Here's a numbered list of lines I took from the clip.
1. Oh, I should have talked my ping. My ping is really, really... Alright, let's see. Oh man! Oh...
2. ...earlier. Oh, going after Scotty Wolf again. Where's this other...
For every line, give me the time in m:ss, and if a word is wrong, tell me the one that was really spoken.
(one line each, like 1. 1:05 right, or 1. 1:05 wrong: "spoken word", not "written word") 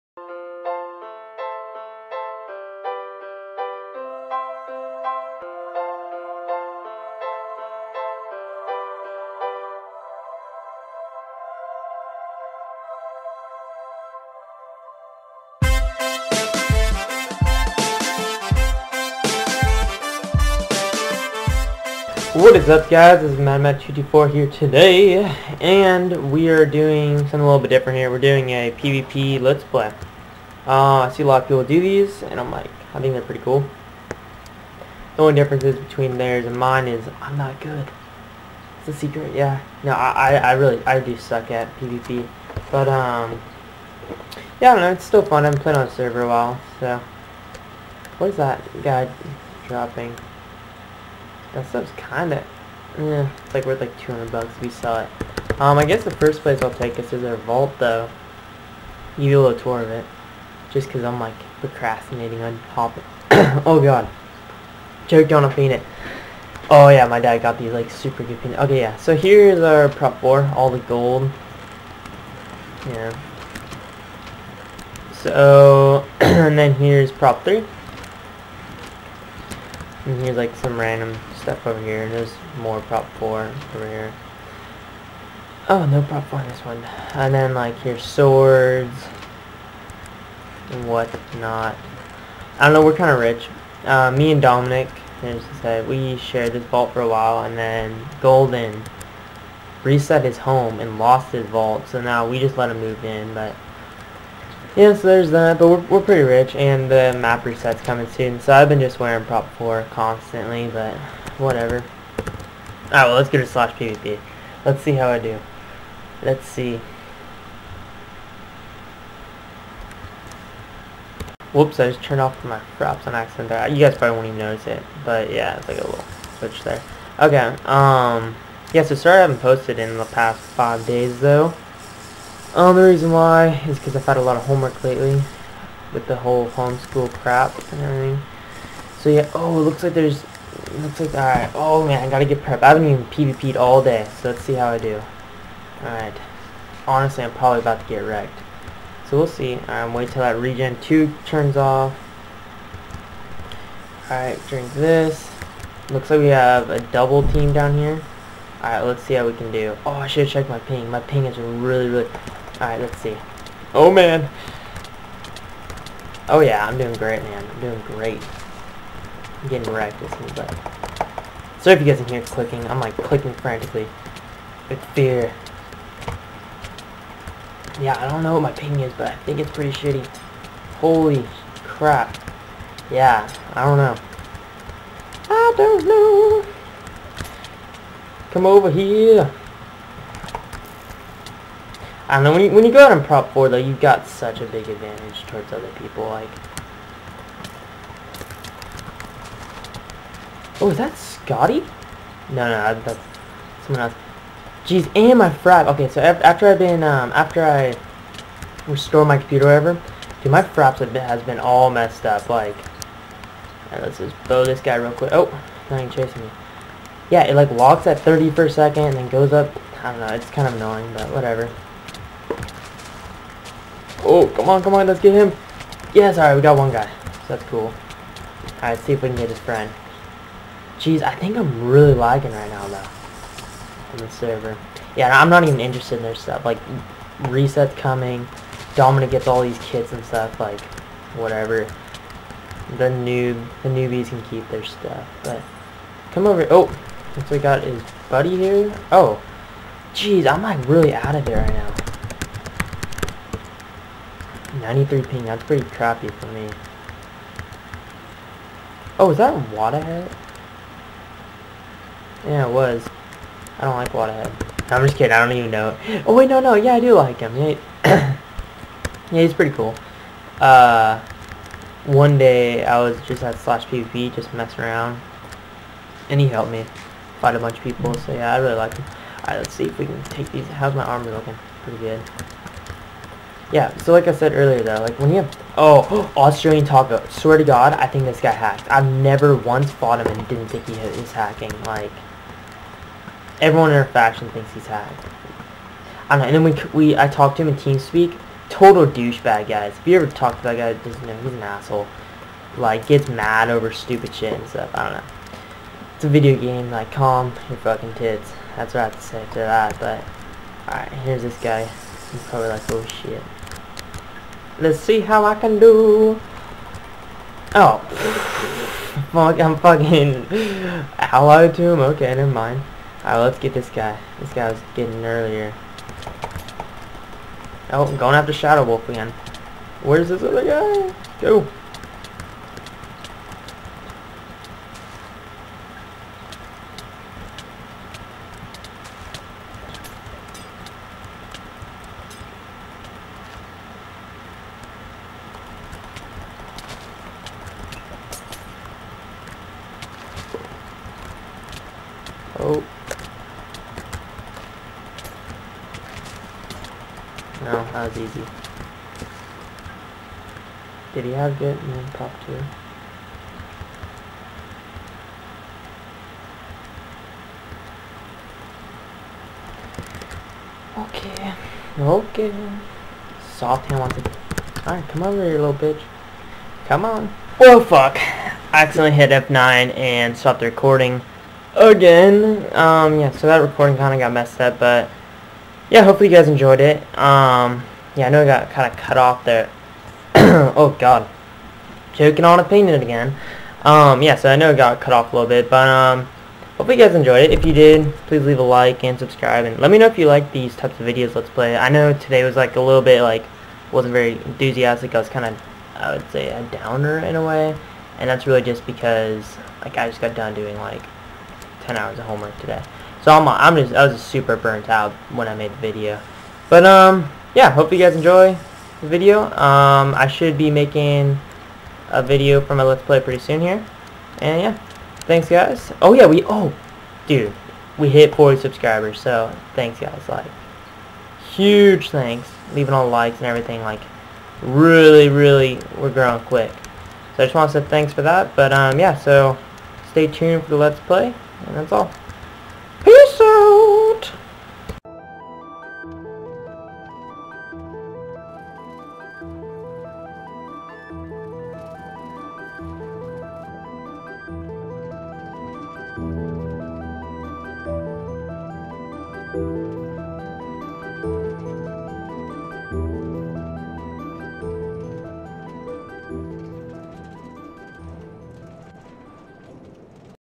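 1. 2:39 wrong: "checked", not "talked"
2. 5:25 wrong: "Shadow", not "Scotty".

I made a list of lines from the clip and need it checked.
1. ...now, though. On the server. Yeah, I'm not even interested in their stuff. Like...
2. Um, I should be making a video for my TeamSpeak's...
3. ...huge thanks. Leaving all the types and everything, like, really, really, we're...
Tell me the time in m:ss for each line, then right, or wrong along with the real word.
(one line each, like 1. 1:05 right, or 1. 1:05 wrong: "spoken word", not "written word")
1. 3:52 right
2. 6:59 wrong: "Let", not "TeamSpeak"
3. 7:11 wrong: "likes", not "types".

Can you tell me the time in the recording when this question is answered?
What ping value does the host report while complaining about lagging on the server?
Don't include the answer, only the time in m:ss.
4:14.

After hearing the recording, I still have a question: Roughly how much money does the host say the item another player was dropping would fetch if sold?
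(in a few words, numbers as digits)
200 bucks.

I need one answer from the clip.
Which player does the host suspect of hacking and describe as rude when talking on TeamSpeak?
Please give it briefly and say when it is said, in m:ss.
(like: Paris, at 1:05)
Australian Taco, at 4:46.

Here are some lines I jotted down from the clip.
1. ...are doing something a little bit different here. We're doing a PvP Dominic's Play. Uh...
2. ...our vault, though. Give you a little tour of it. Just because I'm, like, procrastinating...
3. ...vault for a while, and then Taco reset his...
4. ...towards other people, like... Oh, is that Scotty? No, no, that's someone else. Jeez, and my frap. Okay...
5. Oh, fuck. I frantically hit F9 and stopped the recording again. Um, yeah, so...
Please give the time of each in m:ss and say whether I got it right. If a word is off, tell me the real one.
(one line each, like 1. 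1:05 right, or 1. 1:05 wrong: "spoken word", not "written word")
1. 0:26 wrong: "Let", not "Dominic"
2. 0:57 right
3. 1:36 wrong: "Golden", not "Taco"
4. 3:15 right
5. 6:17 wrong: "accidentally", not "frantically".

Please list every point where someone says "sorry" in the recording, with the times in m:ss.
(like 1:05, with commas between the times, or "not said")
2:08, 2:51.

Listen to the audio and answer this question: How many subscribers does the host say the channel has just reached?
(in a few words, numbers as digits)
40.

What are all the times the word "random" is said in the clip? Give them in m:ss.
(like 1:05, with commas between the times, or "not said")
1:20.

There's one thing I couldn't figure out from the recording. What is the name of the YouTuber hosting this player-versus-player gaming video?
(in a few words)
MadMad224.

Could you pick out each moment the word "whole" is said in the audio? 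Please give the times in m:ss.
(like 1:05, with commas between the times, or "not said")
2:16.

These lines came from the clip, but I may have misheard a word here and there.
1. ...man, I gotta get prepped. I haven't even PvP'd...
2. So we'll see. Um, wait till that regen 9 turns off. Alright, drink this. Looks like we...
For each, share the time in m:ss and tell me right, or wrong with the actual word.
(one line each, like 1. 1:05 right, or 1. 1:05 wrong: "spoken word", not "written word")
1. 2:21 right
2. 2:29 wrong: "2", not "9".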